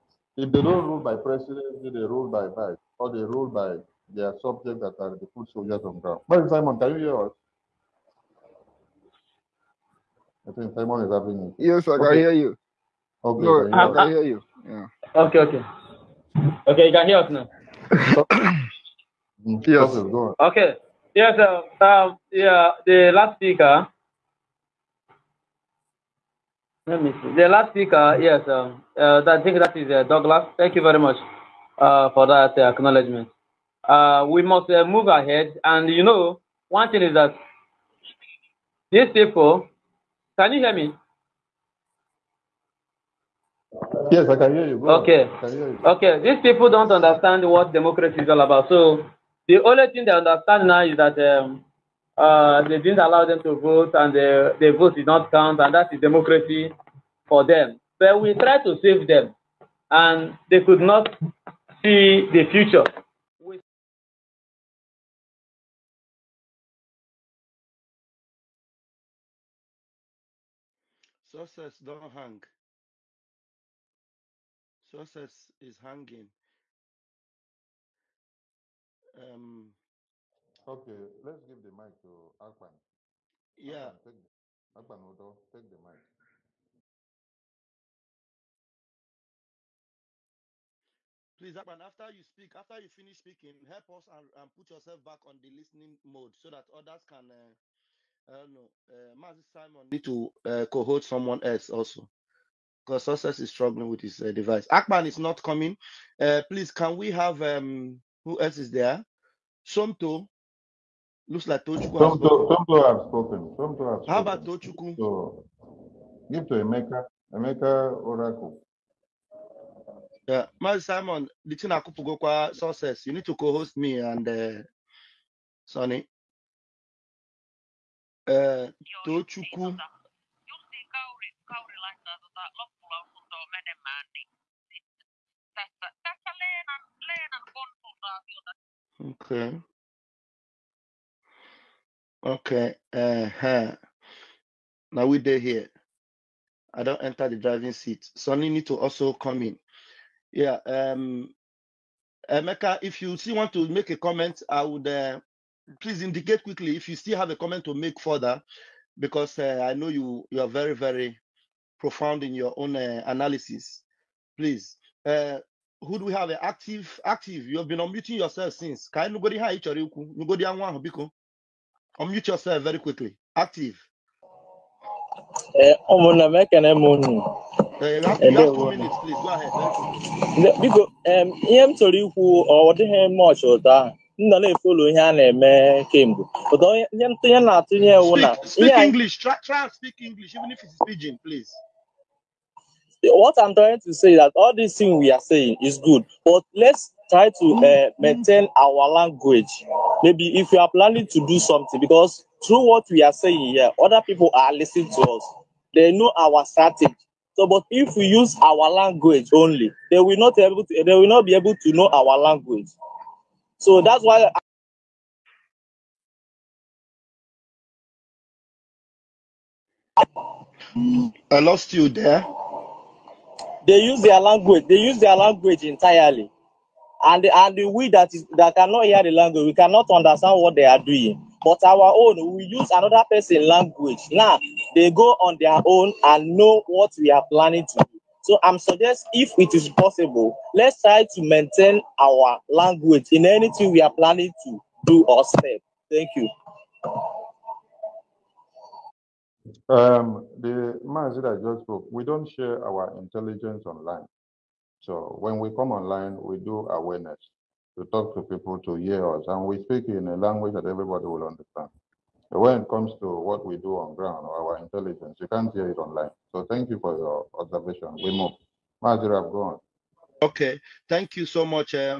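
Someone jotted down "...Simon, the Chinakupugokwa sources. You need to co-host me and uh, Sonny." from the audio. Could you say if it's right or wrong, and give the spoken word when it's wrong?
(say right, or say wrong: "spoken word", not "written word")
right.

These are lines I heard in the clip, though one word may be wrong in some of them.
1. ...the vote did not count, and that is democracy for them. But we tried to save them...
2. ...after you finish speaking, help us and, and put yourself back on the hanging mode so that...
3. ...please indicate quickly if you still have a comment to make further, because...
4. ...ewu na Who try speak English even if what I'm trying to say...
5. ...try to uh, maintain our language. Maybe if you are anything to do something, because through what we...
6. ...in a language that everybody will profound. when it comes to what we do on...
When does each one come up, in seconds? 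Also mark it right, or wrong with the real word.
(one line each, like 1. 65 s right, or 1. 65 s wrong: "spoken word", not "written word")
1. 54 s right
2. 92 s wrong: "listening", not "hanging"
3. 155 s right
4. 187 s wrong: "English", not "Who"
5. 197 s wrong: "planning", not "anything"
6. 259 s wrong: "understand", not "profound".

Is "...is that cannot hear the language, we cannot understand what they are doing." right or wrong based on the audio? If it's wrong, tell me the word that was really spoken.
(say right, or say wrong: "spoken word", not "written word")
right.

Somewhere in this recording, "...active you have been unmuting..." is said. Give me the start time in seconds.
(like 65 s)
167 s.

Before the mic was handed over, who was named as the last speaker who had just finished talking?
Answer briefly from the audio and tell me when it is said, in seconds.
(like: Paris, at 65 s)
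Douglas, at 30 s.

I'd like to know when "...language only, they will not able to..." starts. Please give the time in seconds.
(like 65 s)
208 s.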